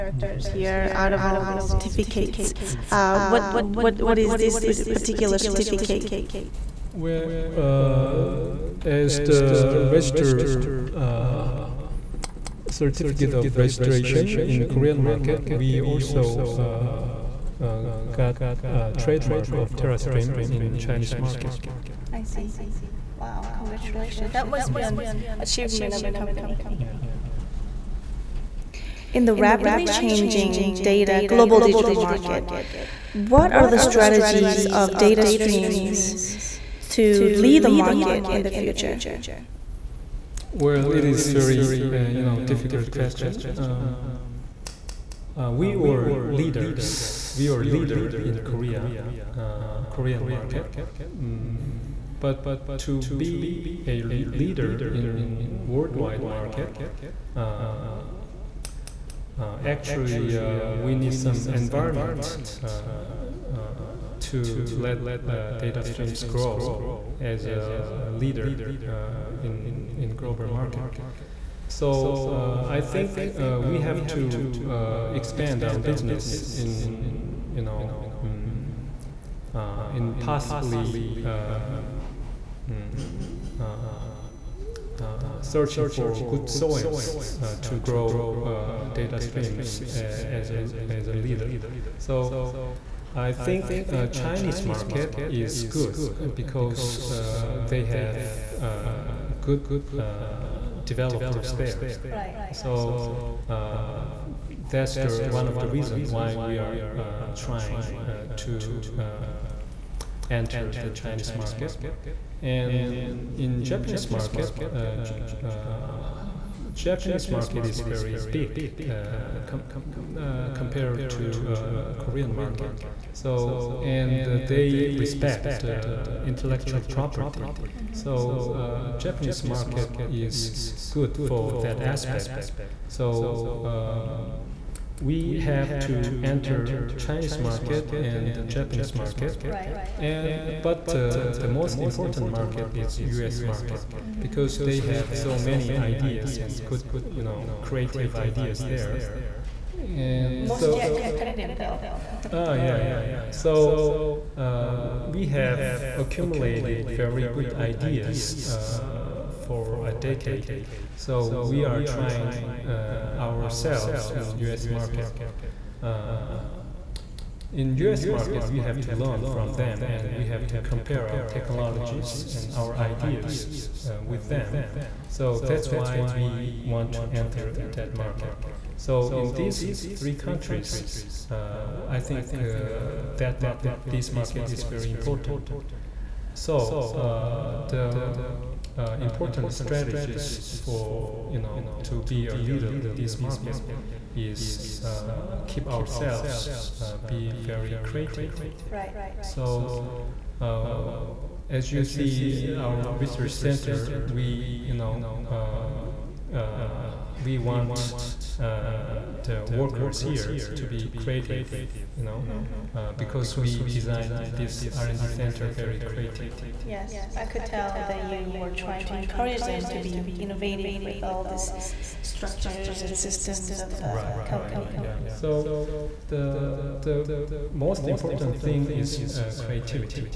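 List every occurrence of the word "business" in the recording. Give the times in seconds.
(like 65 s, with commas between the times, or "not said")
75 s.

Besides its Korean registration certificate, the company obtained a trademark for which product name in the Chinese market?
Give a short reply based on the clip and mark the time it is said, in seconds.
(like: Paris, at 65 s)
TeraStream, at 19 s.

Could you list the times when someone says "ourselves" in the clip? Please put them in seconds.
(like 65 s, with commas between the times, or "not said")
163 s, 195 s.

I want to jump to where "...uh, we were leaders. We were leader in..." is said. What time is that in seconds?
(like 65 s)
45 s.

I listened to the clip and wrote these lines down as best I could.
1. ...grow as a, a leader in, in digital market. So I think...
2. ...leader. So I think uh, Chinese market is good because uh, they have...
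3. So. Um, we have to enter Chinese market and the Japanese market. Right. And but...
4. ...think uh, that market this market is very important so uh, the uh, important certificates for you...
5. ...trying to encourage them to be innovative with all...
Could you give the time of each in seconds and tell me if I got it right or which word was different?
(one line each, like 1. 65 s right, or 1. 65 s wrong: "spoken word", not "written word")
1. 66 s wrong: "global", not "digital"
2. 91 s right
3. 132 s right
4. 182 s wrong: "strategies", not "certificates"
5. 218 s right.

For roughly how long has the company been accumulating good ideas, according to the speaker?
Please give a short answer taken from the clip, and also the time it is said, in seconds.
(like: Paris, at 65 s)
a decade, at 159 s.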